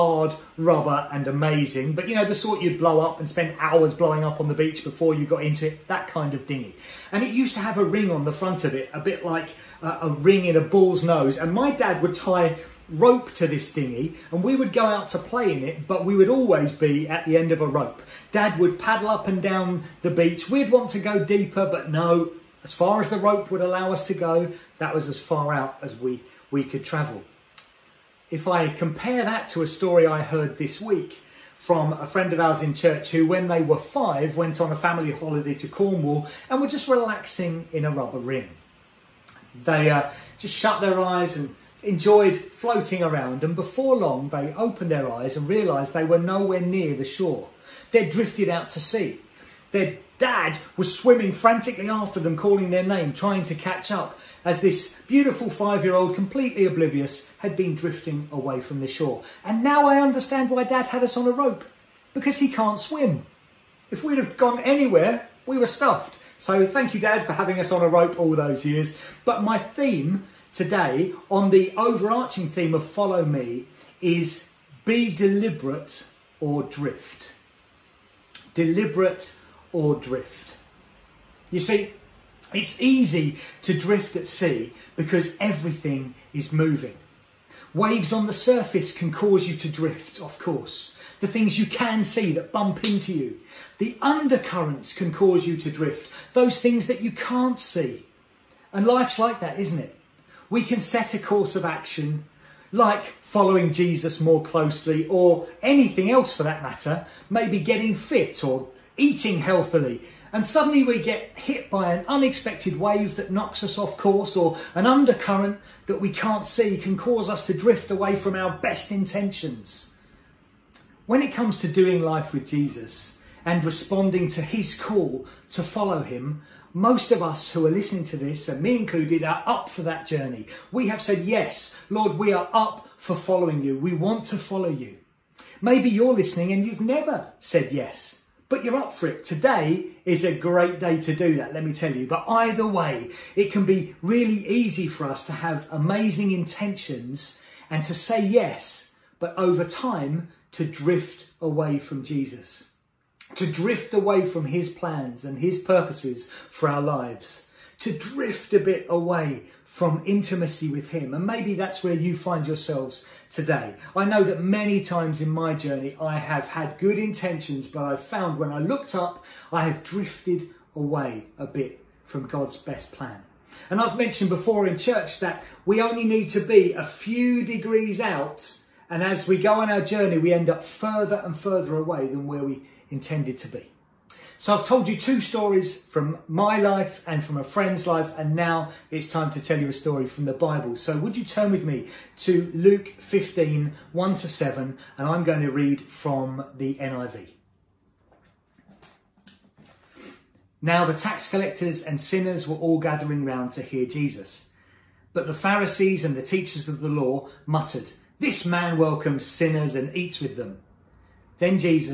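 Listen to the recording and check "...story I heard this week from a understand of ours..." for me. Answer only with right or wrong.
wrong.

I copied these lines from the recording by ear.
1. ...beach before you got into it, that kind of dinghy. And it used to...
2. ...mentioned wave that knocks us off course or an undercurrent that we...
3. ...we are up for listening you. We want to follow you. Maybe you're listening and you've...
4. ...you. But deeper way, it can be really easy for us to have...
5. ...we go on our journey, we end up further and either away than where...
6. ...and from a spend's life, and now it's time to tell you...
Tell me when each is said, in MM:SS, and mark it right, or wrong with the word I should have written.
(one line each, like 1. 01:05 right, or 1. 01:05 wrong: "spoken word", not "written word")
1. 00:04 right
2. 01:52 wrong: "unexpected", not "mentioned"
3. 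02:12 wrong: "following", not "listening"
4. 02:21 wrong: "either", not "deeper"
5. 02:59 wrong: "further", not "either"
6. 03:07 wrong: "friend", not "spend".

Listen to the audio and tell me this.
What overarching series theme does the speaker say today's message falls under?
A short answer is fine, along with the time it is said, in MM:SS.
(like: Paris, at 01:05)
Follow Me, at 01:12.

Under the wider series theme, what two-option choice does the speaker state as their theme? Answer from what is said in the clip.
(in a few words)
Be deliberate or drift.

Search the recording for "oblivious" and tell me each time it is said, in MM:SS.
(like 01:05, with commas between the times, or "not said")
00:56.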